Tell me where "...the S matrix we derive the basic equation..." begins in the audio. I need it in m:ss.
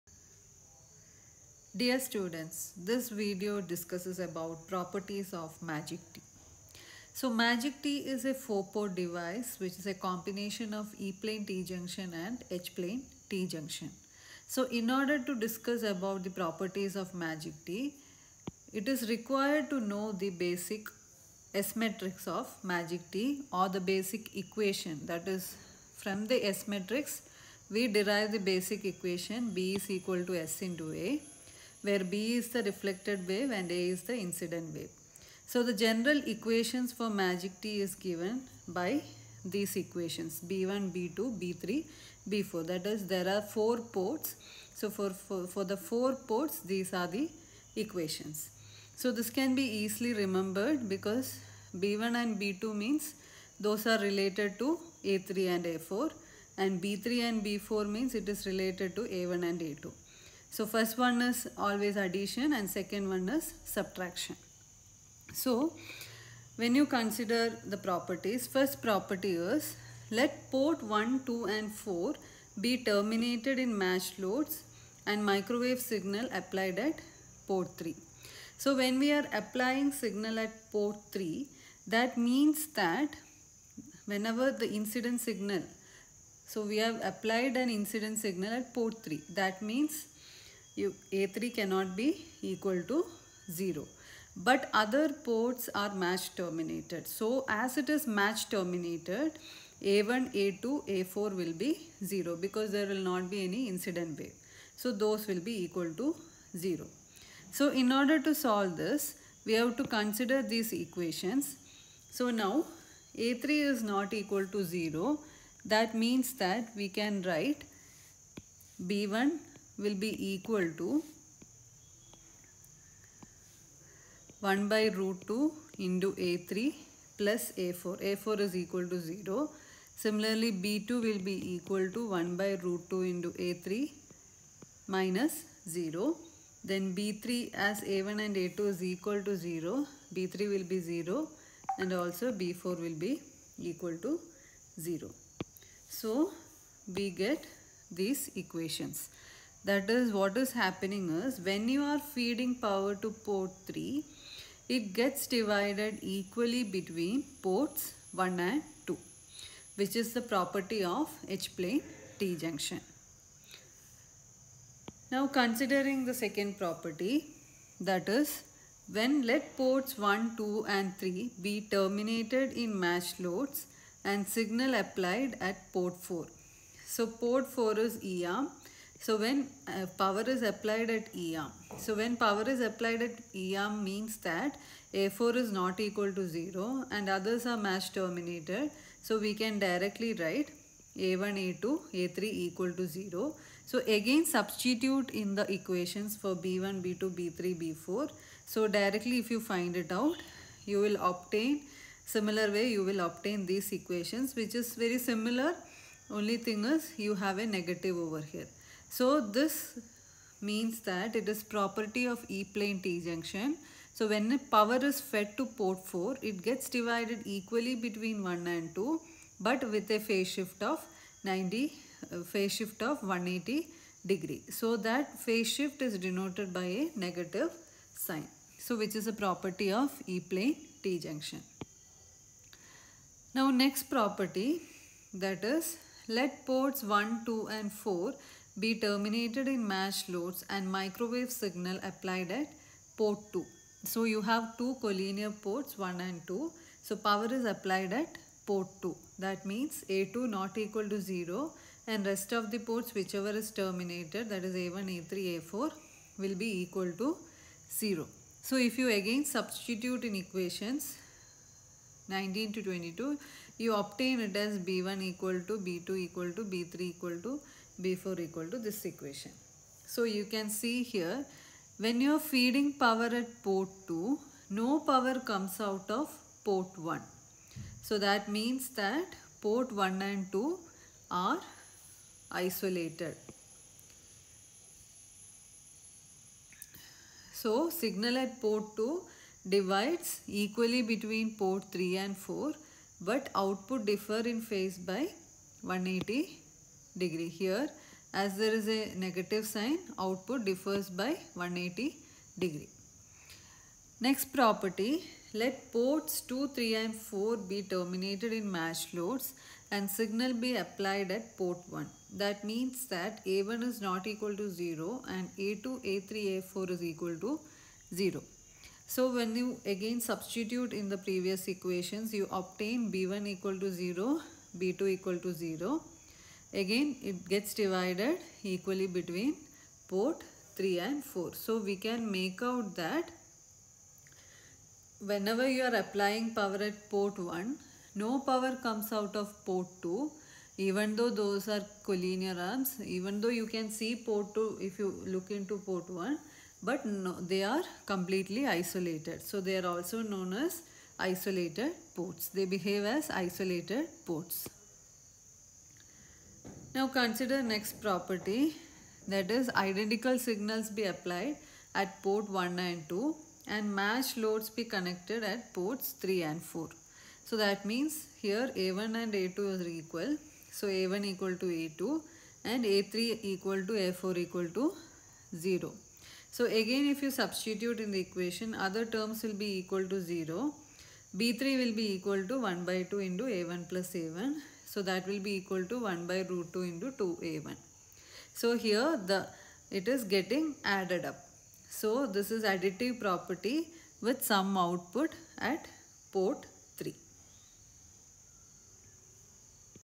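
0:26.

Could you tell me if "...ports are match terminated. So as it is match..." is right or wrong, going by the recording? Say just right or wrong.
right.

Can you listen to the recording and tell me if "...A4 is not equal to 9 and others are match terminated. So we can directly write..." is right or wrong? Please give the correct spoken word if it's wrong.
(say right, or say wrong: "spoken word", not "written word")
wrong: "0", not "9".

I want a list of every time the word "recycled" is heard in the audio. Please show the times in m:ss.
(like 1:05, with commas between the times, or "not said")
not said.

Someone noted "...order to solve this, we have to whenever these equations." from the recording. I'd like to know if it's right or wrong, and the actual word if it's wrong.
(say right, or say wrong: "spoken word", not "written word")
wrong: "consider", not "whenever".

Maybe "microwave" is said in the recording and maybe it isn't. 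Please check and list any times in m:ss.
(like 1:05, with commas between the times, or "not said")
1:15, 4:00.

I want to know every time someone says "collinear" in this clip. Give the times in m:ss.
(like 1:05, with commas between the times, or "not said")
4:04, 5:41.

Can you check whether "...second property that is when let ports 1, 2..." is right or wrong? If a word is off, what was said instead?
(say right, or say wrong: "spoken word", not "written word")
right.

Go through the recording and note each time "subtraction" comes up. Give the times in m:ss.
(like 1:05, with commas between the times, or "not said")
1:03.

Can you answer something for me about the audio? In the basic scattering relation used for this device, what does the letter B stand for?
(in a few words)
reflected wave.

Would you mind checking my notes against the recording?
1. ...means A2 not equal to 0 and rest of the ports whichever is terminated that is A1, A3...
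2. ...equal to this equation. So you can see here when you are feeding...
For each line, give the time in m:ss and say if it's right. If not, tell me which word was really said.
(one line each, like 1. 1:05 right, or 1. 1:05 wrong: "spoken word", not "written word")
1. 4:09 right
2. 4:28 right.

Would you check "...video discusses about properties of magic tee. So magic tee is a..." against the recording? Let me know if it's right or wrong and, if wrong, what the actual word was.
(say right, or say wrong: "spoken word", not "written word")
right.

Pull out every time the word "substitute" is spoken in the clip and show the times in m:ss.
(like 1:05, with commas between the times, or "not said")
3:14, 4:19, 5:20, 6:17.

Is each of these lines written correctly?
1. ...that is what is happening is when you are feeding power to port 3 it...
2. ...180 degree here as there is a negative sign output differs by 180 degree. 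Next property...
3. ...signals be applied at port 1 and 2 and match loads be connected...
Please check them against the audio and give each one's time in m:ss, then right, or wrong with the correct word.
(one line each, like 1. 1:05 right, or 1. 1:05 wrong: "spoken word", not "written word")
1. 2:29 right
2. 4:55 right
3. 6:00 right.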